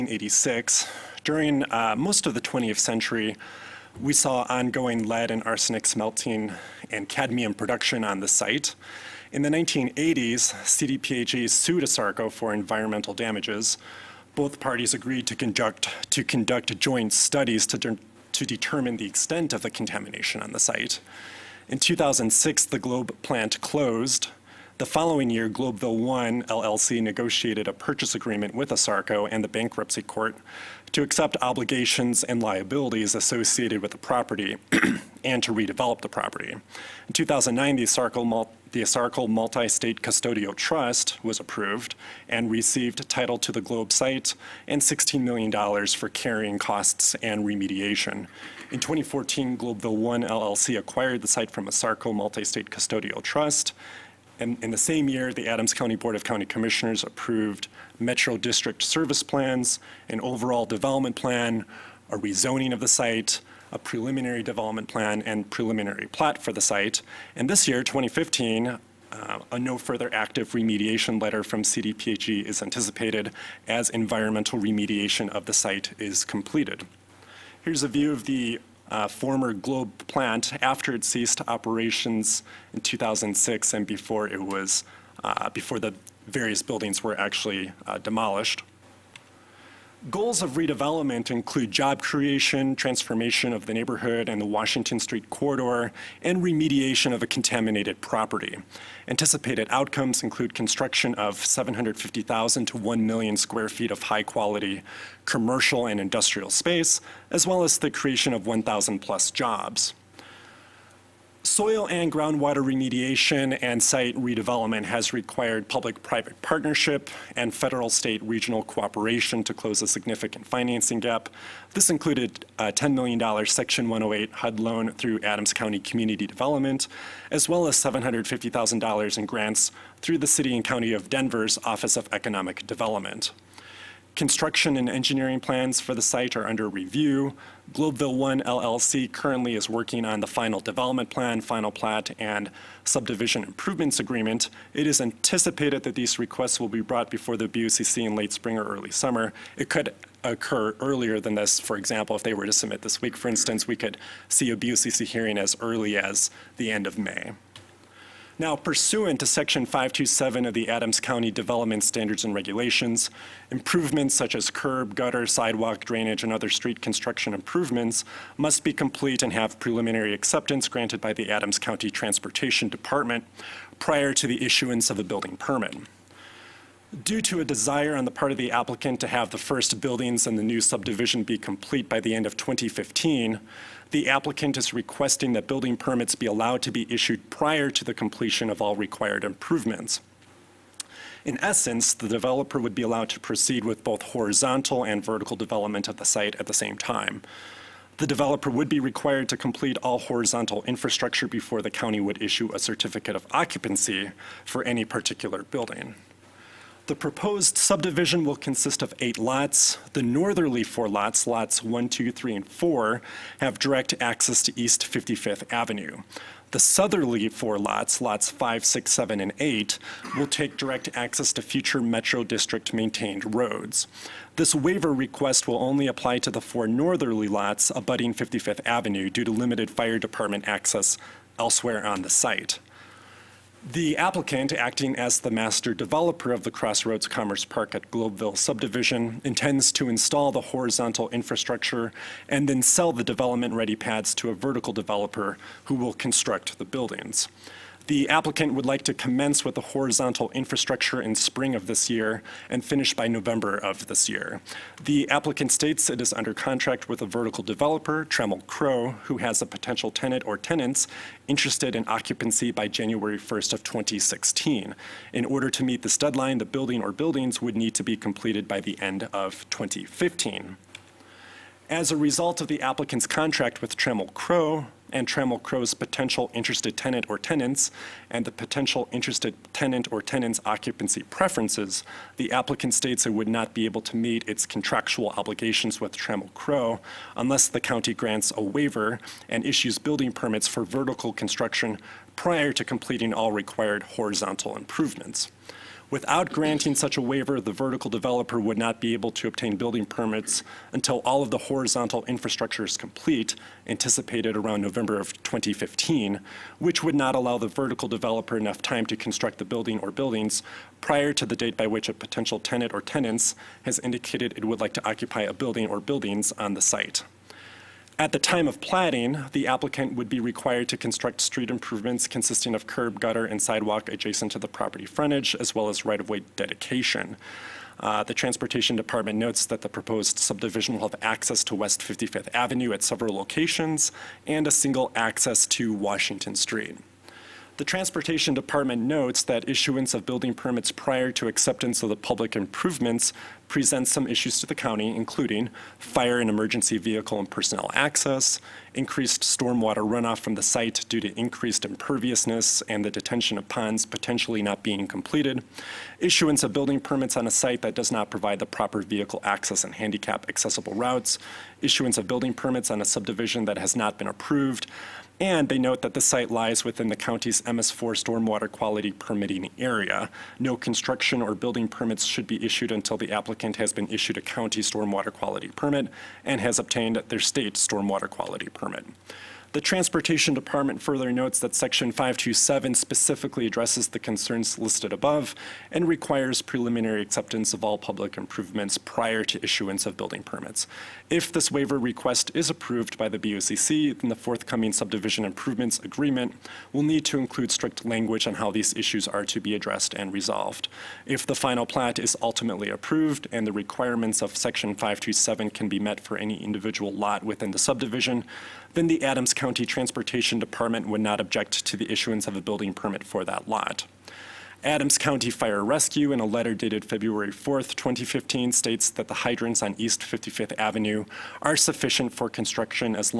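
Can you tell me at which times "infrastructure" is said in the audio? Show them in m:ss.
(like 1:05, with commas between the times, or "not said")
3:20, 4:01, 4:10, 5:02.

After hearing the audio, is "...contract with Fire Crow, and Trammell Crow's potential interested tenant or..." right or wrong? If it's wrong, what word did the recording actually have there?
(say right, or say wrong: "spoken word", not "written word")
wrong: "Trammell", not "Fire".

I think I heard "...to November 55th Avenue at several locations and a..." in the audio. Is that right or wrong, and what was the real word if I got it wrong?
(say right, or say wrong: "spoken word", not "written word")
wrong: "West", not "November".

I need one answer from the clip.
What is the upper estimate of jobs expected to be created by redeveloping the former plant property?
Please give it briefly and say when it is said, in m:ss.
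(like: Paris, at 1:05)
1,000 plus, at 1:48.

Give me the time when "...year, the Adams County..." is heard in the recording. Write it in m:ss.
0:55.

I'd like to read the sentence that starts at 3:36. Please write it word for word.
The southerly four lots, lots 5, 6, 7, and 8, will take direct access to future Metro District maintained roads.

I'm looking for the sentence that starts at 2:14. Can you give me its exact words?
Construction and engineering plans for the site are under review.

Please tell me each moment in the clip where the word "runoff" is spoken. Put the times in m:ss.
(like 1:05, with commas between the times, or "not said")
5:49.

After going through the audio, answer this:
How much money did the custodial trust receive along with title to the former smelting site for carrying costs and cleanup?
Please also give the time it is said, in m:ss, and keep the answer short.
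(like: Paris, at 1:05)
$16 million, at 0:44.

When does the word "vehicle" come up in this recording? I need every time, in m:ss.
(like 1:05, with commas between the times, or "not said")
5:46, 5:58.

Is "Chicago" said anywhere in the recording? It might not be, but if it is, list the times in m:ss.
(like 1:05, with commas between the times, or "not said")
not said.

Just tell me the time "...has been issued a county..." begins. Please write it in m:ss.
6:13.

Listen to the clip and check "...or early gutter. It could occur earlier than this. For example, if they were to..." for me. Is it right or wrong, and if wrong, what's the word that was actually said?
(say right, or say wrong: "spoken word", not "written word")
wrong: "summer", not "gutter".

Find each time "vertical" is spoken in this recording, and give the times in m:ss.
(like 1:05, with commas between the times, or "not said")
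3:15, 4:04, 4:17, 4:50, 4:57, 5:07.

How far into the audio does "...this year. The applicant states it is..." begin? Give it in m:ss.
4:13.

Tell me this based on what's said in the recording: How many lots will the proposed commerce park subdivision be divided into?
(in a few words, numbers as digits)
8.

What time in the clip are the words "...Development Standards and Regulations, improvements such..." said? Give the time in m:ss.
2:41.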